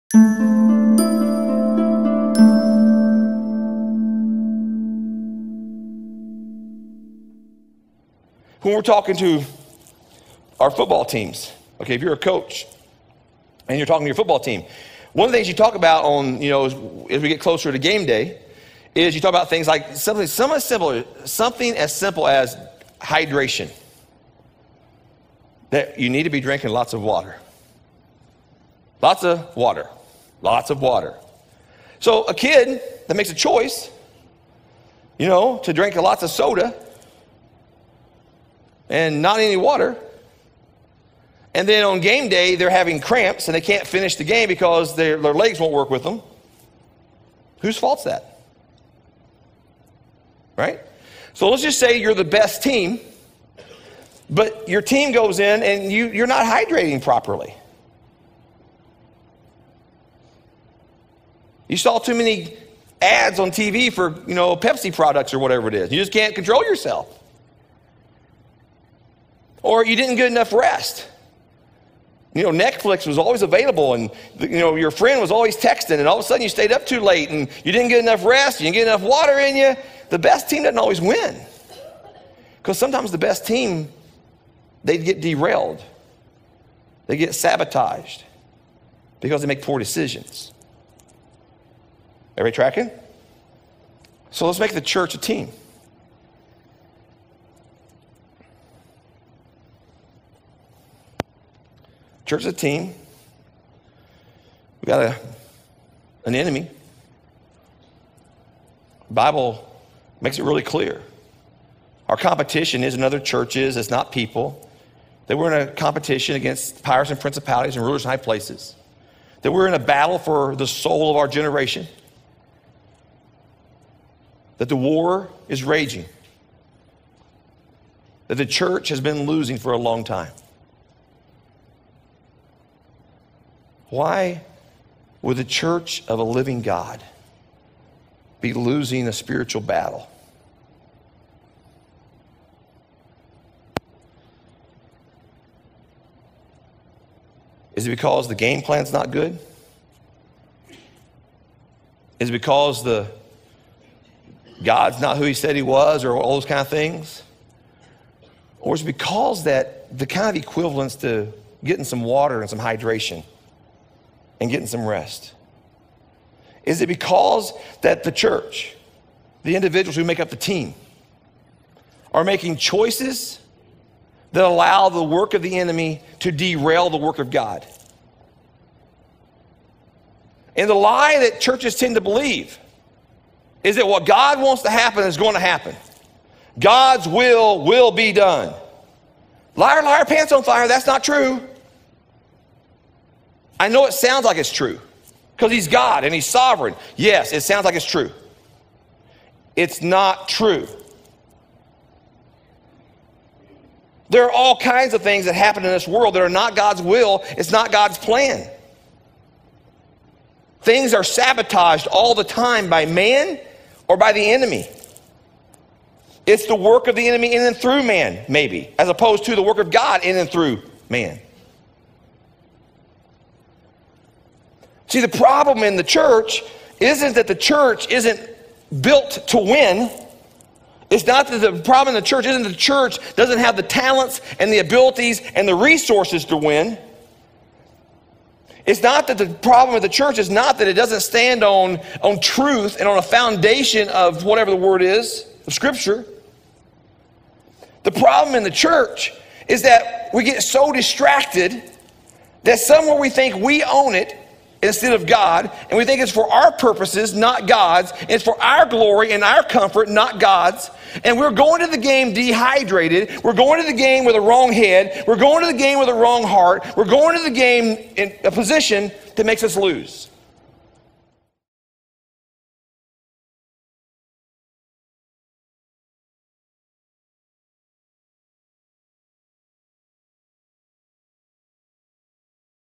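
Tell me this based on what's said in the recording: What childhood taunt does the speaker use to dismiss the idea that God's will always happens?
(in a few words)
Liar, liar, pants on fire.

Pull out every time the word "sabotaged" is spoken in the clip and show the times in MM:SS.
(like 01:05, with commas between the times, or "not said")
01:27, 03:31.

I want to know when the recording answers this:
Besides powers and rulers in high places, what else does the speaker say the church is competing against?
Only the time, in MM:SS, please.
01:57.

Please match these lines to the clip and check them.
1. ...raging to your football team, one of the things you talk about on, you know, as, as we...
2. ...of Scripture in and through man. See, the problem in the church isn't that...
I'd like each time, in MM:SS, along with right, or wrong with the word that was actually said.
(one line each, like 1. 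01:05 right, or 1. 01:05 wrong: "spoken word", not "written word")
1. 00:13 wrong: "talking", not "raging"
2. 03:39 wrong: "God", not "Scripture".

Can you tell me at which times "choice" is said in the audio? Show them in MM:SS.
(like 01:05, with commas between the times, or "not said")
00:33, 02:52.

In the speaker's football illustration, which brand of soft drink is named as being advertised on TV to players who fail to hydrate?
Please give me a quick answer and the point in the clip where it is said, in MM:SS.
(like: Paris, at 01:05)
Pepsi, at 01:04.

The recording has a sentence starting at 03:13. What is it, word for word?
I know it sounds like it's true because he's God and he's sovereign.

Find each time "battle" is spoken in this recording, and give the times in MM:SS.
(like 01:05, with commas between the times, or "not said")
01:59, 02:19.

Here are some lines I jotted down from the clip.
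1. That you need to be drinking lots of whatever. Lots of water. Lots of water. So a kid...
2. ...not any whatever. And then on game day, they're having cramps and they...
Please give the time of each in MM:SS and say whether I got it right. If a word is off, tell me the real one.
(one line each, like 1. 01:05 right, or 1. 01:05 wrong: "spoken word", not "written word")
1. 00:25 wrong: "water", not "whatever"
2. 00:39 wrong: "water", not "whatever".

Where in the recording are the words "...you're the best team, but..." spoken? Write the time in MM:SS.
00:51.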